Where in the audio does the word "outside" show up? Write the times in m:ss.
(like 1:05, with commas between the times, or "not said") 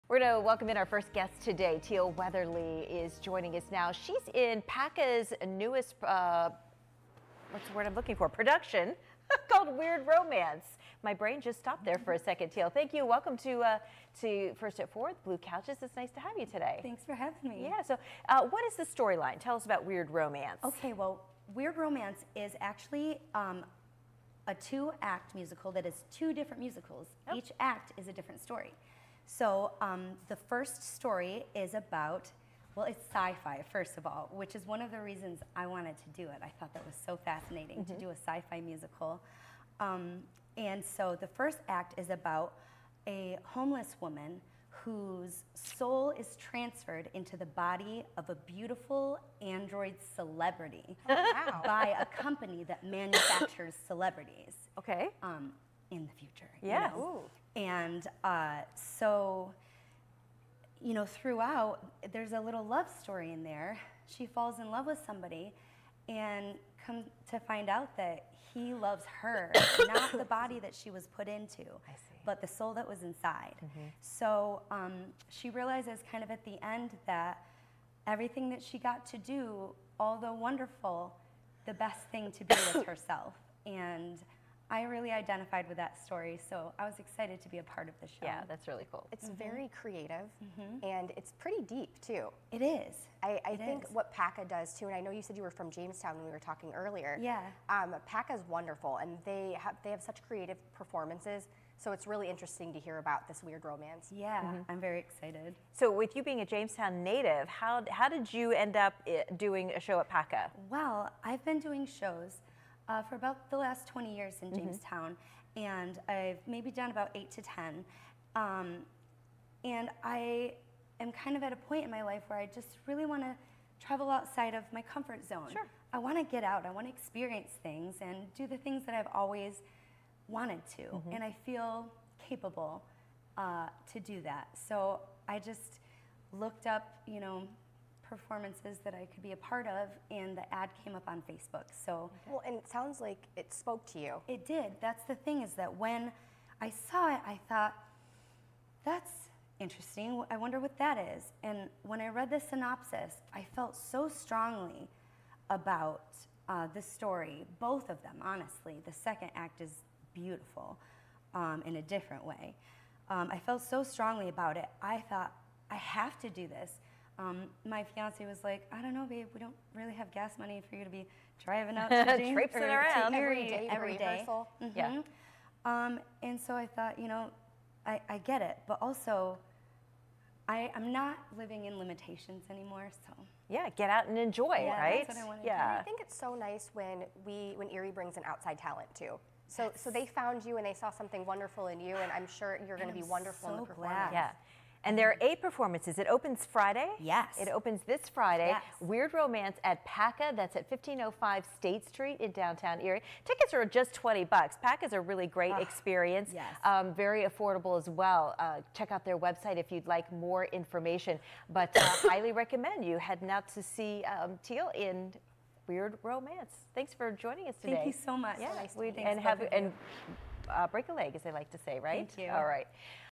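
2:04, 3:08.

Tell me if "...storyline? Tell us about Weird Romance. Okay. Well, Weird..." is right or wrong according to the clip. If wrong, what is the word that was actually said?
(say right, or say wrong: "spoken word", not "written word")
right.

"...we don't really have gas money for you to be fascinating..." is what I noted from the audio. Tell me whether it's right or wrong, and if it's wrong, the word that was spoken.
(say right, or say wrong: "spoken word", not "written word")
wrong: "driving", not "fascinating".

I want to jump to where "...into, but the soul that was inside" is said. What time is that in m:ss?
1:11.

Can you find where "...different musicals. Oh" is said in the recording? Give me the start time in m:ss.
0:26.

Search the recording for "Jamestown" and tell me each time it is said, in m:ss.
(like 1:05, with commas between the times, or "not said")
1:35, 1:46, 1:54.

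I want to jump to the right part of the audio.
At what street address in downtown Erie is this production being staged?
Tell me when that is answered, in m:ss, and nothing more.
3:20.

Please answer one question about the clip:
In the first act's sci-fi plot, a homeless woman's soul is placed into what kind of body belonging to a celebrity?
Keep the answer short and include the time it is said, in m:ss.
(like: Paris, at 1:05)
android, at 0:49.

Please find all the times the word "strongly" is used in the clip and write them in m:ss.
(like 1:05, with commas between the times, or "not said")
2:34, 2:43.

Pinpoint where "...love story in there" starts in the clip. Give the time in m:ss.
1:02.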